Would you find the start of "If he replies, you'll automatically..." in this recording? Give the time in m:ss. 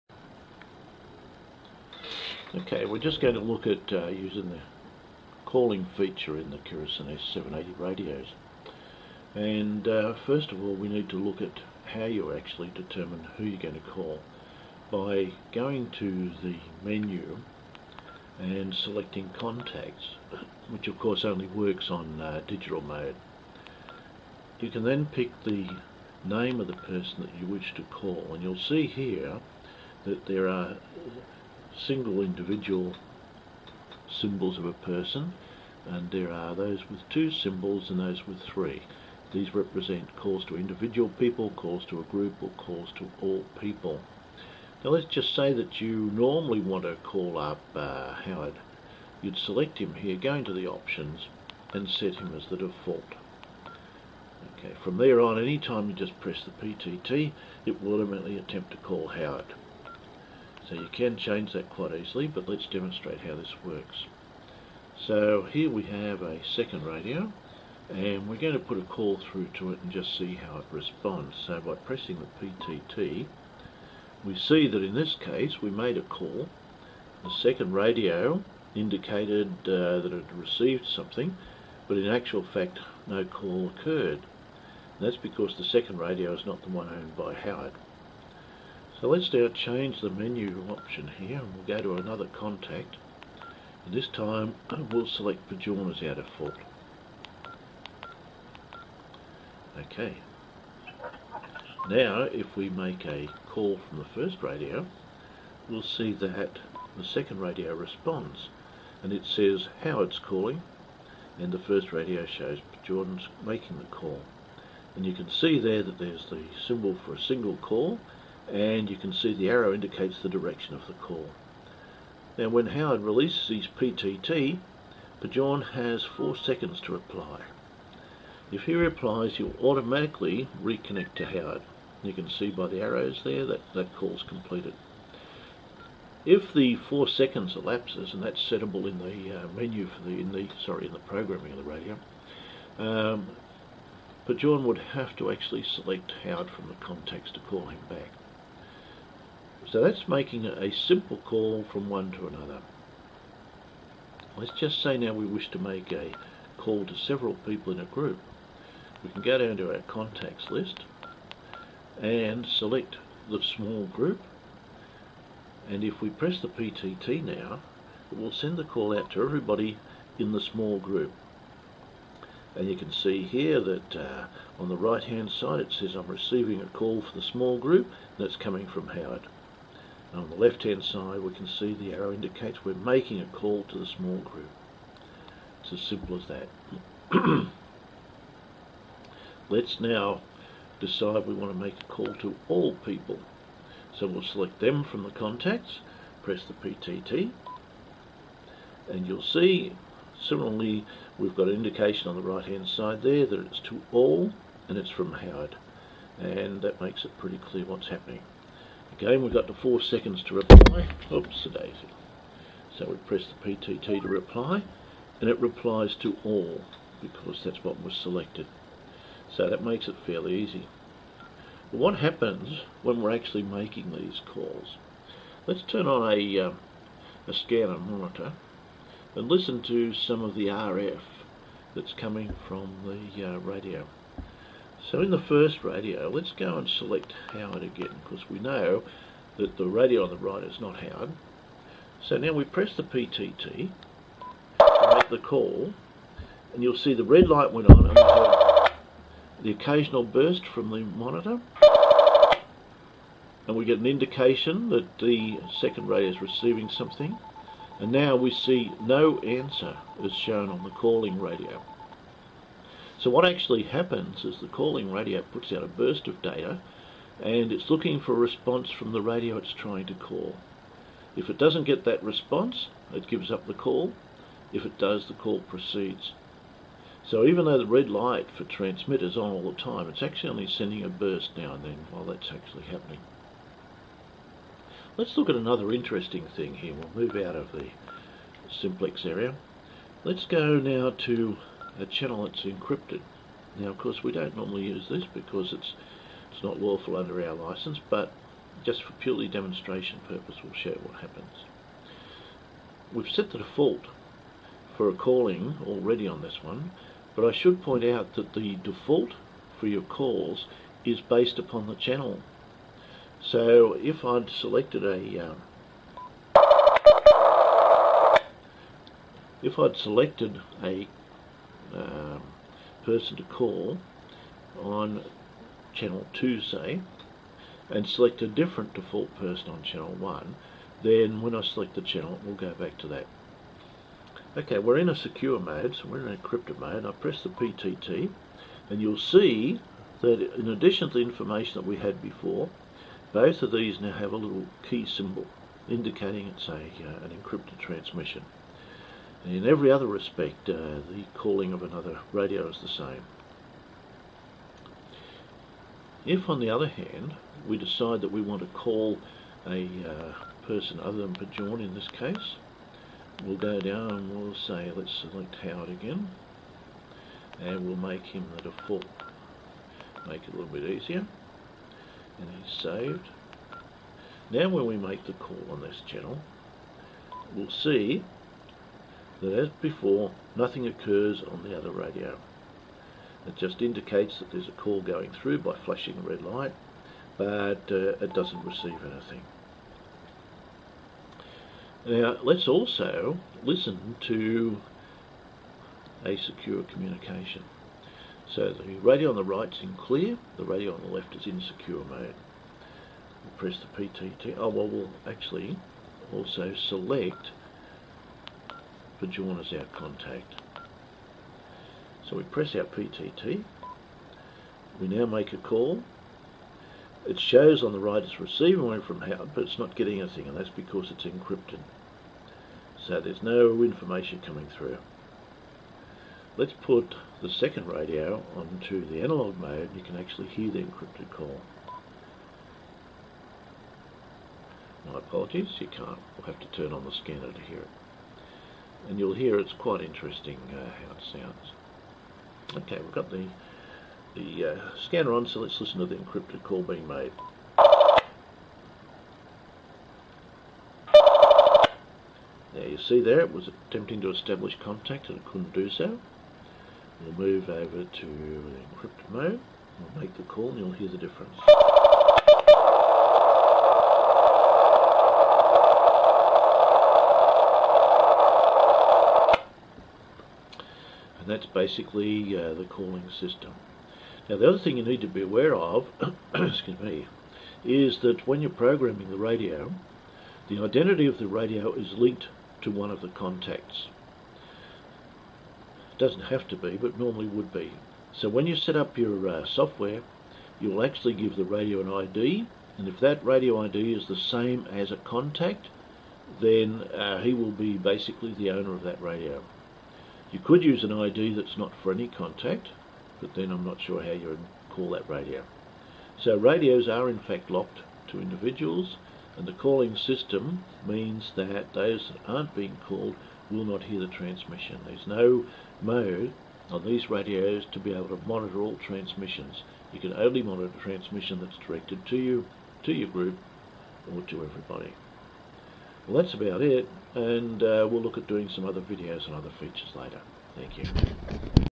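2:08.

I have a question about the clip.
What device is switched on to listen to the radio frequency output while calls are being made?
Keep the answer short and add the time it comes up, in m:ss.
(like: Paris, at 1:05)
scanner monitor, at 3:47.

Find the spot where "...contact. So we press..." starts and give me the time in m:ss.
6:49.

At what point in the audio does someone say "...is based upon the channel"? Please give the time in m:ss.
5:10.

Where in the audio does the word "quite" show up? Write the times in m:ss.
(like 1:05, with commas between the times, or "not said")
1:01, 7:19.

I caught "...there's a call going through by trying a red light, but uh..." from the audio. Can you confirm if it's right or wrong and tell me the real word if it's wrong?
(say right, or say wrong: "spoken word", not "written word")
wrong: "flashing", not "trying".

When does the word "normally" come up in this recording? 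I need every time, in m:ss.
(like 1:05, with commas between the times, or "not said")
0:46, 4:54, 8:06.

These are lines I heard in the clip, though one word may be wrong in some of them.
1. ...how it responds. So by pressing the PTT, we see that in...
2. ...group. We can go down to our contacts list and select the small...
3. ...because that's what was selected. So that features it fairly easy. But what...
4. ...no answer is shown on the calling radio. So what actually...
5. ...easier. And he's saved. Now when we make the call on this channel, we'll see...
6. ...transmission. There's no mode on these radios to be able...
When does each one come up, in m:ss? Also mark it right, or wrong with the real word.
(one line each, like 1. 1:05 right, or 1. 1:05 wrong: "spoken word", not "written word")
1. 1:10 right
2. 2:37 right
3. 3:37 wrong: "makes", not "features"
4. 4:18 right
5. 6:10 right
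6. 8:34 right.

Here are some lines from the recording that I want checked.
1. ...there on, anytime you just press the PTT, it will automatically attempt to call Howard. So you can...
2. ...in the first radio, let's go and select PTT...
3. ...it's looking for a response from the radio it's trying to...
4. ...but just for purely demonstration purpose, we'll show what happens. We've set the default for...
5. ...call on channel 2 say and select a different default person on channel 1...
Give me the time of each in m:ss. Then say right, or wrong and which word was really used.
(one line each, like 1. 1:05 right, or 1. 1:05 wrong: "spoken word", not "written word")
1. 0:54 right
2. 3:55 wrong: "Howard", not "PTT"
3. 4:27 right
4. 4:57 right
5. 5:23 right.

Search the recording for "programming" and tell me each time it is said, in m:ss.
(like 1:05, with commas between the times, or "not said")
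2:20, 7:58.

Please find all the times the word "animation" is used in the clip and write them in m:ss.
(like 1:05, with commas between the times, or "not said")
not said.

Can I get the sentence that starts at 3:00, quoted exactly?
And on the left hand side we can see the arrow indicates we're making a call to the small group.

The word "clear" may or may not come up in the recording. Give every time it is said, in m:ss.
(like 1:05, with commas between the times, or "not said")
3:27, 6:39.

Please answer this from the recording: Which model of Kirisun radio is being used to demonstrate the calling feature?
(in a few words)
S780.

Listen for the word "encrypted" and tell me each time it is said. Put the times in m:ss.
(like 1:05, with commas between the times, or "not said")
4:52, 5:36, 5:47, 7:01, 7:10, 7:25, 7:38.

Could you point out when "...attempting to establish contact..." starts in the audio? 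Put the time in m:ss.
7:33.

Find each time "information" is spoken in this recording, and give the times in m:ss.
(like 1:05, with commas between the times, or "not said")
5:41, 7:03.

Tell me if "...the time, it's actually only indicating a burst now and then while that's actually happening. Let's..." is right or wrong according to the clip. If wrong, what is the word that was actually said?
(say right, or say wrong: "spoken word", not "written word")
wrong: "sending", not "indicating".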